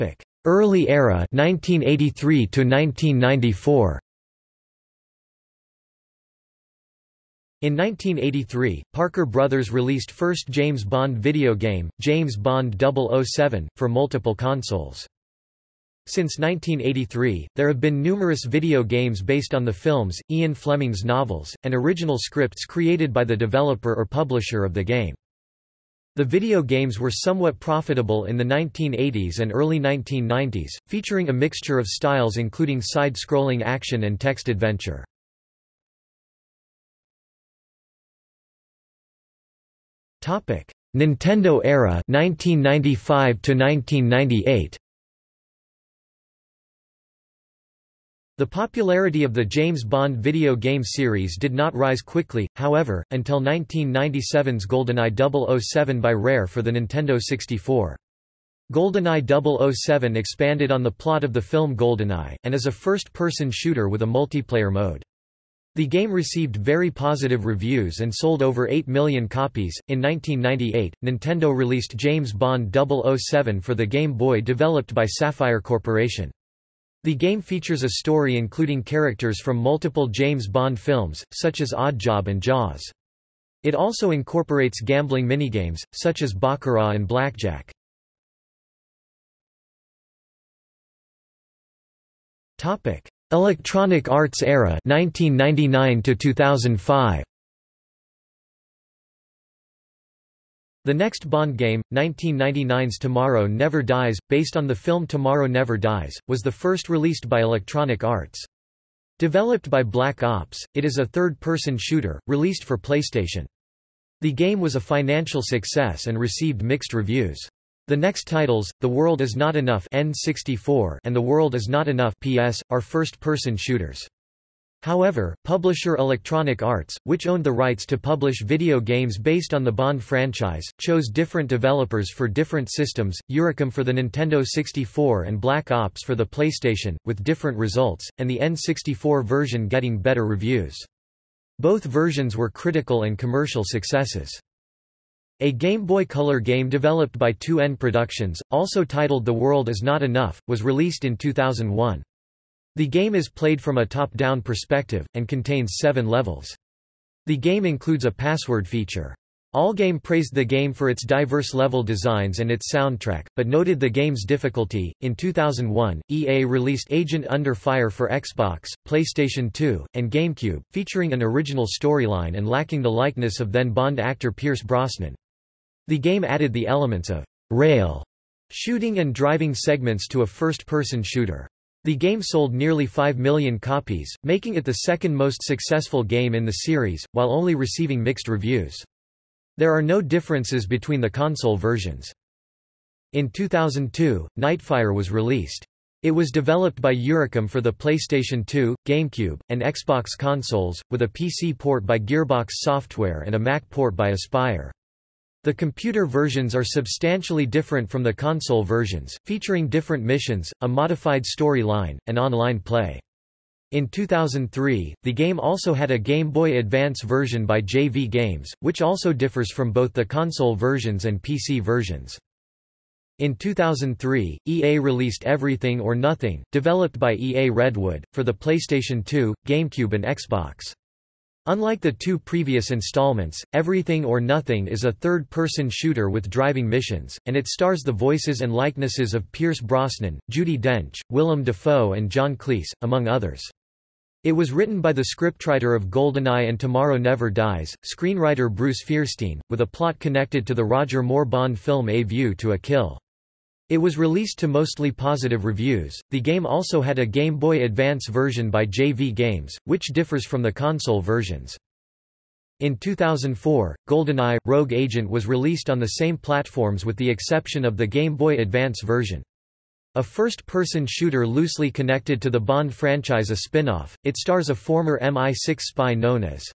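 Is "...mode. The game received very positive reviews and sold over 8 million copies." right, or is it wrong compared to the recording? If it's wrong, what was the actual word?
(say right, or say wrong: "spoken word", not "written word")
right.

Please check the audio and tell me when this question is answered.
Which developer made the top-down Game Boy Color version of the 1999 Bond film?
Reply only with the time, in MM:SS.
02:27.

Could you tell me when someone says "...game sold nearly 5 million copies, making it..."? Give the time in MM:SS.
03:01.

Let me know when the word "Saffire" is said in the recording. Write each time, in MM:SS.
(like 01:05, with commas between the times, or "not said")
01:15.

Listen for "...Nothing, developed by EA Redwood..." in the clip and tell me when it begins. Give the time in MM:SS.
03:45.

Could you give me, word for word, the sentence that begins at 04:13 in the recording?
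It was released to mostly positive reviews.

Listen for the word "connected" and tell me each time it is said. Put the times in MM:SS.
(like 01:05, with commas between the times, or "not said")
04:09, 04:31.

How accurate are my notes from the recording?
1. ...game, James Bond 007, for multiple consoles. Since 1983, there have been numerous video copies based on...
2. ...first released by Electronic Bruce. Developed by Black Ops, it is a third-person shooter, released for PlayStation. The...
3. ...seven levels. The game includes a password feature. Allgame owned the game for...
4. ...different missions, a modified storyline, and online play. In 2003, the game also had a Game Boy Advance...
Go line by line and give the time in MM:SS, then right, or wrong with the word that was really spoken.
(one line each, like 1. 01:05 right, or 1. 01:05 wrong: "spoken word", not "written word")
1. 00:11 wrong: "games", not "copies"
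2. 01:46 wrong: "Arts", not "Bruce"
3. 02:35 wrong: "praised", not "owned"
4. 03:29 right.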